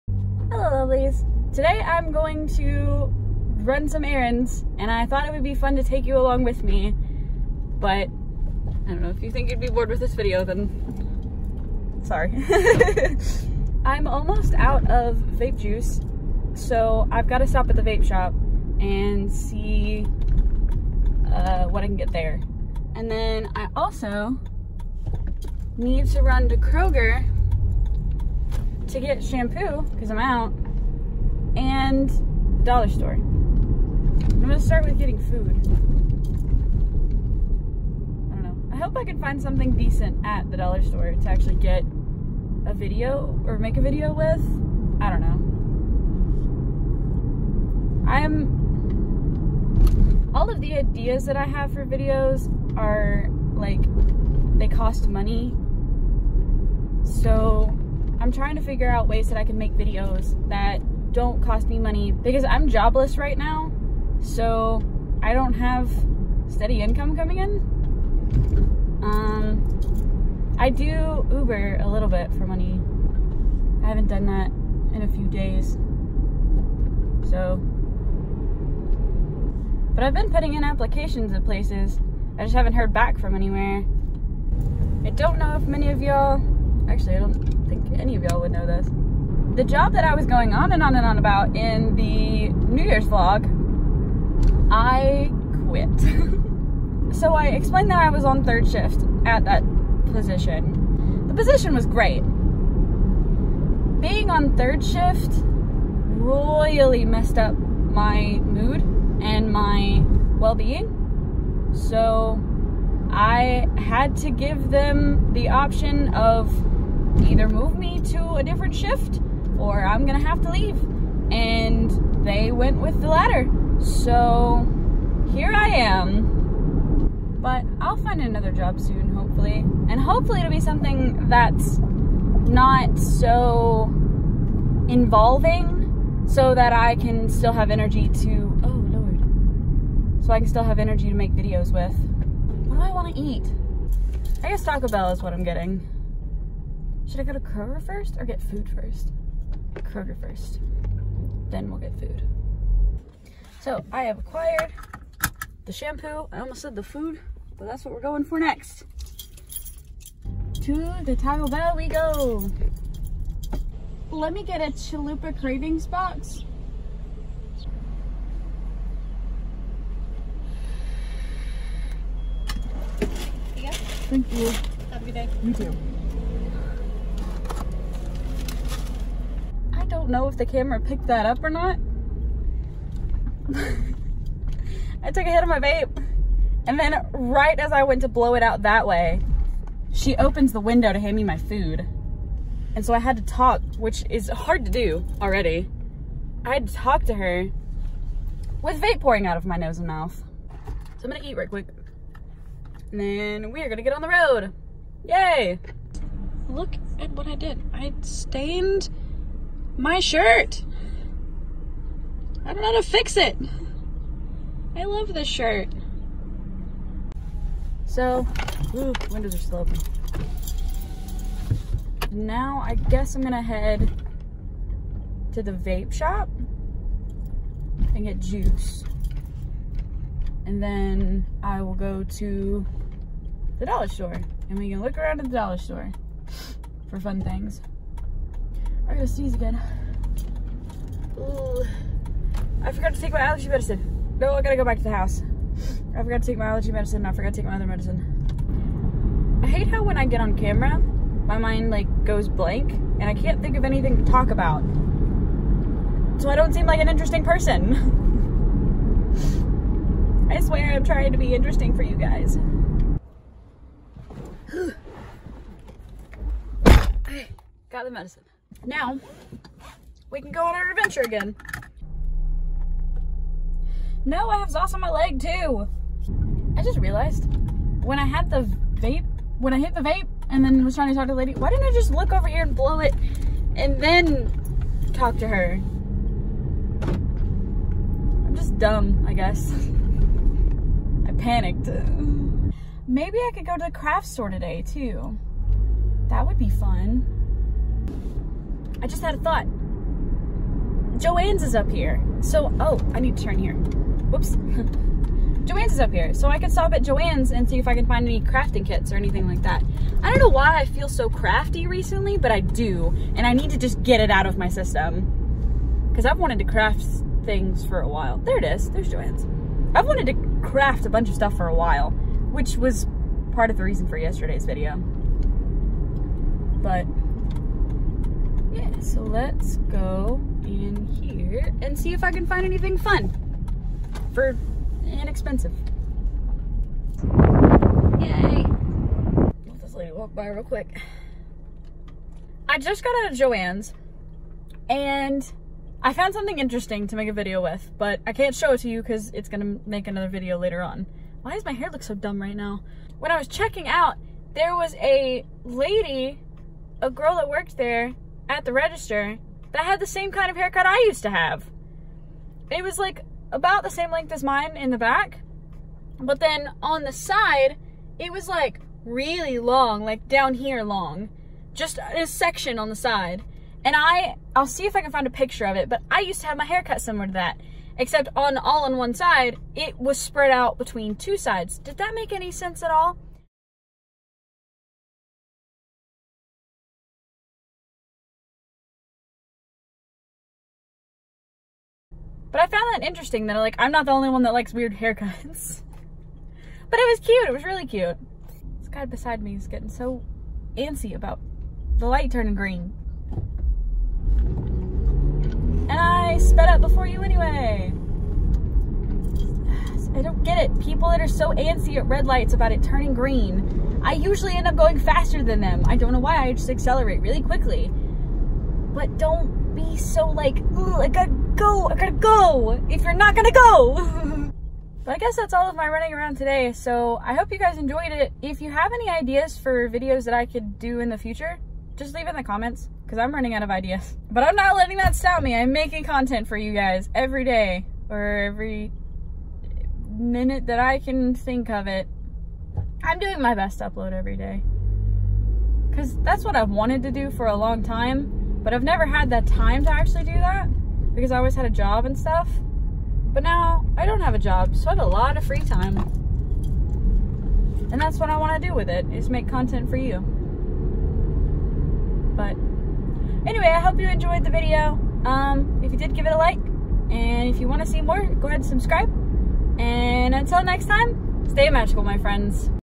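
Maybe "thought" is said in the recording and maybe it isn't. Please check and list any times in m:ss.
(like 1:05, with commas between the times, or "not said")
0:05, 4:59.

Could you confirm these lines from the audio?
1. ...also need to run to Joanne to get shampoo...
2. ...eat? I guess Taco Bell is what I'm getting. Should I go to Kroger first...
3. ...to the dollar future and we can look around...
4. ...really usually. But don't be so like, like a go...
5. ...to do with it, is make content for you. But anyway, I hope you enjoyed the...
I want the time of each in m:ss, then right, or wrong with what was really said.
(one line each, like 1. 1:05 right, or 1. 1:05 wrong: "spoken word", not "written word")
1. 0:23 wrong: "Kroger", not "Joanne"
2. 2:23 right
3. 3:52 wrong: "store", not "future"
4. 6:57 wrong: "quickly", not "usually"
5. 7:38 right.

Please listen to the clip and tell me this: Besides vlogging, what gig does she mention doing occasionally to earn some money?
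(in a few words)
Uber.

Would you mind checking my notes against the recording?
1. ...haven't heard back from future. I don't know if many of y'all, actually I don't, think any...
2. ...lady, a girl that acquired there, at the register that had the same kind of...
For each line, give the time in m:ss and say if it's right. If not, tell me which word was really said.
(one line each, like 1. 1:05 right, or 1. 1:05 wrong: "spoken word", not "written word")
1. 1:22 wrong: "anywhere", not "future"
2. 5:55 wrong: "worked", not "acquired".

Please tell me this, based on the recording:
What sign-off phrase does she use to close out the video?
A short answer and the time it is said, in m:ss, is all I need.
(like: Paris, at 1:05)
Stay magical, at 7:51.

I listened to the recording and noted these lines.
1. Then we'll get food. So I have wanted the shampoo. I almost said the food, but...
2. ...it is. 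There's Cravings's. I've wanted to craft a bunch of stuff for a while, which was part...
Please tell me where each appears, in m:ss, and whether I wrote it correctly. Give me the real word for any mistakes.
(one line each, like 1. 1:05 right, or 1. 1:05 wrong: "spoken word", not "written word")
1. 2:31 wrong: "acquired", not "wanted"
2. 5:18 wrong: "Joanne", not "Cravings".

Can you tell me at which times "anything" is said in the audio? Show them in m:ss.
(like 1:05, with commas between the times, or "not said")
4:13, 5:08, 5:32.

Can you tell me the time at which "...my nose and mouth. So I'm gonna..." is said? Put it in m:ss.
3:19.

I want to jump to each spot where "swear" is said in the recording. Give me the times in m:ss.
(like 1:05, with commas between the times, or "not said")
4:20.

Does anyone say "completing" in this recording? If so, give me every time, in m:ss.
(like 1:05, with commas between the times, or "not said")
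not said.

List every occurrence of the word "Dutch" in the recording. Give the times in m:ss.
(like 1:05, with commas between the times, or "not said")
not said.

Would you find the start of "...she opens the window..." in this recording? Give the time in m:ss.
3:09.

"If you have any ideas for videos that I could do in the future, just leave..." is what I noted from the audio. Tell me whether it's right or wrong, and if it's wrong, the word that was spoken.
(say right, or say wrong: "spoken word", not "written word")
right.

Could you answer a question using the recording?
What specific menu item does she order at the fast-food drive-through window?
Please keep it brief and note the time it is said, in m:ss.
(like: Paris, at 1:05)
Chalupa Cravings box, at 2:44.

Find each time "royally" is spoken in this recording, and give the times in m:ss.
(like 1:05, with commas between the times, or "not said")
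1:45.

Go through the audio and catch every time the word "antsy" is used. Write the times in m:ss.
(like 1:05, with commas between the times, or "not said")
6:40, 6:51.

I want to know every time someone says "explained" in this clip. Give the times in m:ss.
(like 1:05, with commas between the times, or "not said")
1:37.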